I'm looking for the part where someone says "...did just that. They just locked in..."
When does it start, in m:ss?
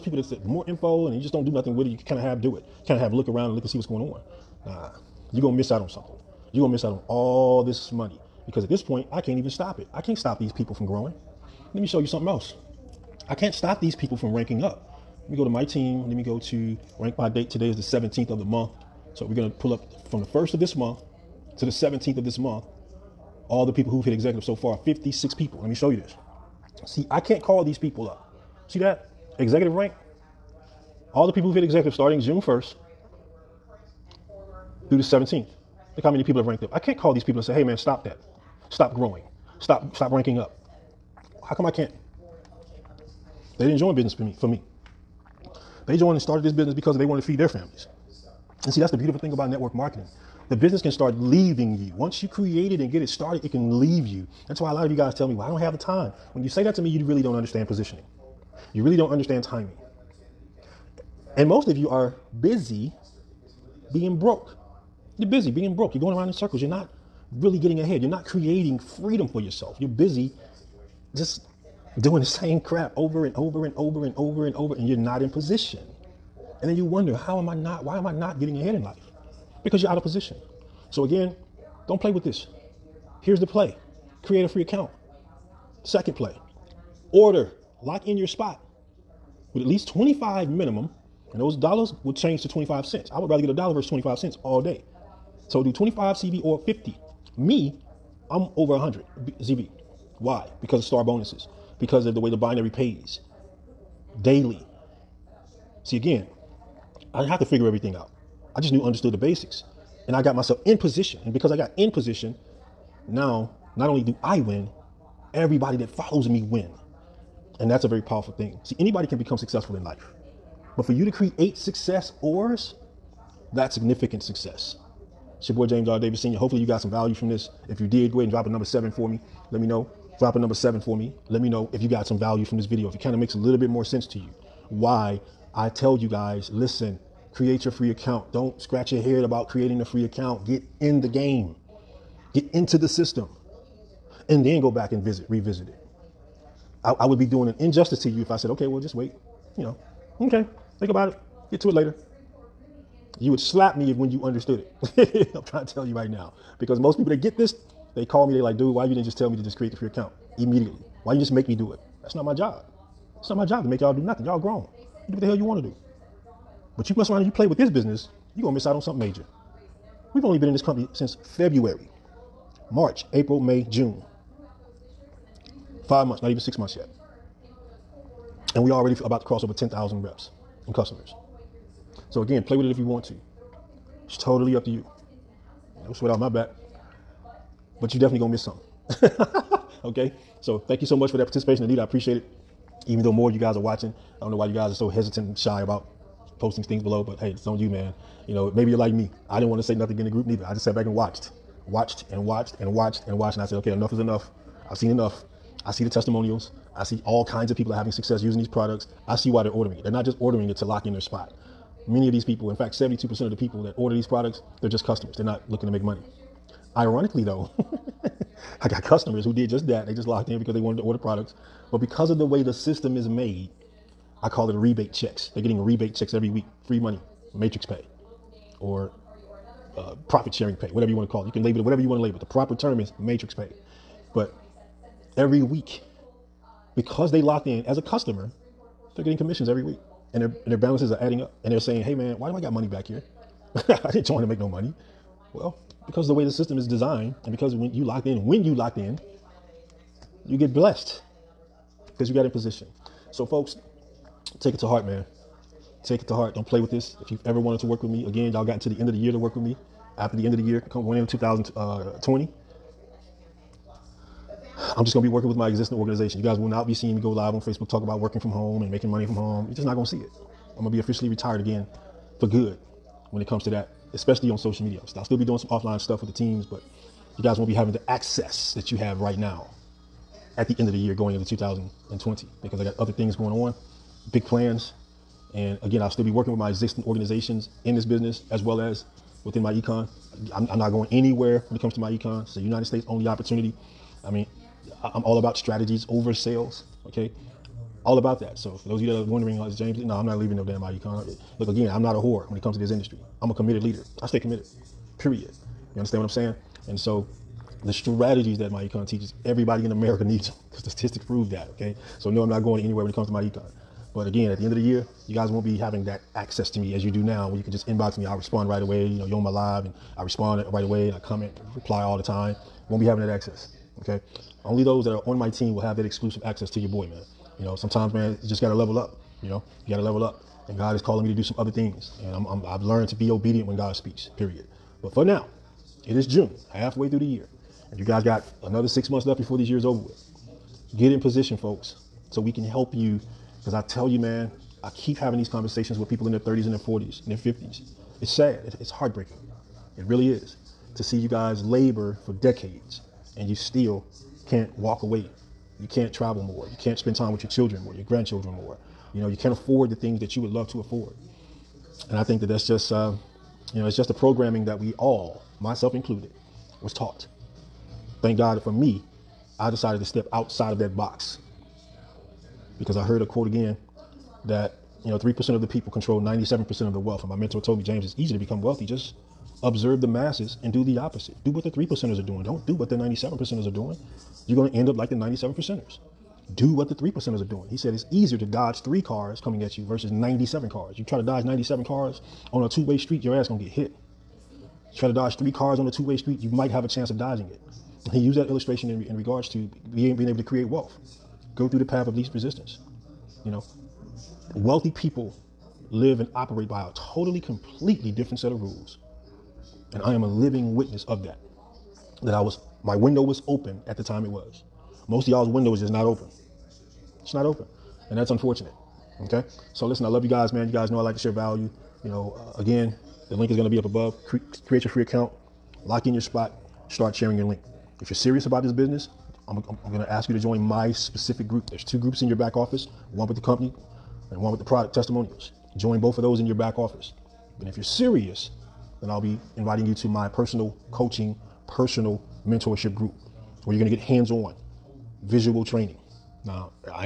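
3:39.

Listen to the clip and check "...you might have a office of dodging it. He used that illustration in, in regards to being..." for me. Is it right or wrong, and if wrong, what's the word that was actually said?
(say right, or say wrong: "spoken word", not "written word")
wrong: "chance", not "office".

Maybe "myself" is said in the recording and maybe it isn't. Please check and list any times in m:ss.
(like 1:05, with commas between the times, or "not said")
1:50, 6:05.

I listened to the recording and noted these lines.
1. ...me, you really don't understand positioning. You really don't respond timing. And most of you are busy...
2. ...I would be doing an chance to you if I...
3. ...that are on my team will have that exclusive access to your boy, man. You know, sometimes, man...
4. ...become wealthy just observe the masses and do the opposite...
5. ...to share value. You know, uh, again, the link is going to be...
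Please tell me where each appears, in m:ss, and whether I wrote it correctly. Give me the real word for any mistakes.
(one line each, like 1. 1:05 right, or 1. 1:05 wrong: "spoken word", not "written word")
1. 0:56 wrong: "understand", not "respond"
2. 2:26 wrong: "injustice", not "chance"
3. 5:24 right
4. 6:18 right
5. 7:00 right.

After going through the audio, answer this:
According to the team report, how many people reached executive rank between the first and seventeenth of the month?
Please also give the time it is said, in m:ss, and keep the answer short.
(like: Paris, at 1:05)
56, at 0:24.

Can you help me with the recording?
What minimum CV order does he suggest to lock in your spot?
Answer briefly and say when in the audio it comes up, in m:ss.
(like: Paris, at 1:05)
25, at 1:29.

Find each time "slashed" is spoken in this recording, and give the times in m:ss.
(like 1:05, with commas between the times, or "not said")
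not said.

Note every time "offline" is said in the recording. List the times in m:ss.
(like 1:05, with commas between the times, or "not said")
4:35.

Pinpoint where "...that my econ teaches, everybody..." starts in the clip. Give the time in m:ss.
5:08.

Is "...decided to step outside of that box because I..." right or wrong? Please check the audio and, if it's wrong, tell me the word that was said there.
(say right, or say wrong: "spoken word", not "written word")
right.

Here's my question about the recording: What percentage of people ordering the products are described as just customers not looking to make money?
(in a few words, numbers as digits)
72%.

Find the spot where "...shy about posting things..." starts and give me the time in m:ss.
3:15.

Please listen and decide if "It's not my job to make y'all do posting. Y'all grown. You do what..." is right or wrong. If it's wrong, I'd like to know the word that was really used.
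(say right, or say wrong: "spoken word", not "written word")
wrong: "nothing", not "posting".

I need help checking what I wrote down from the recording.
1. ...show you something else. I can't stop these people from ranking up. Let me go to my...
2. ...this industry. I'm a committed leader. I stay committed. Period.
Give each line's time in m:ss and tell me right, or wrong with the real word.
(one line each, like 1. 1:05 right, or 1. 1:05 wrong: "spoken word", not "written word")
1. 0:11 right
2. 5:02 right.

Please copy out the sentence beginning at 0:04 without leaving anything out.
Nah, you're gonna miss out on something.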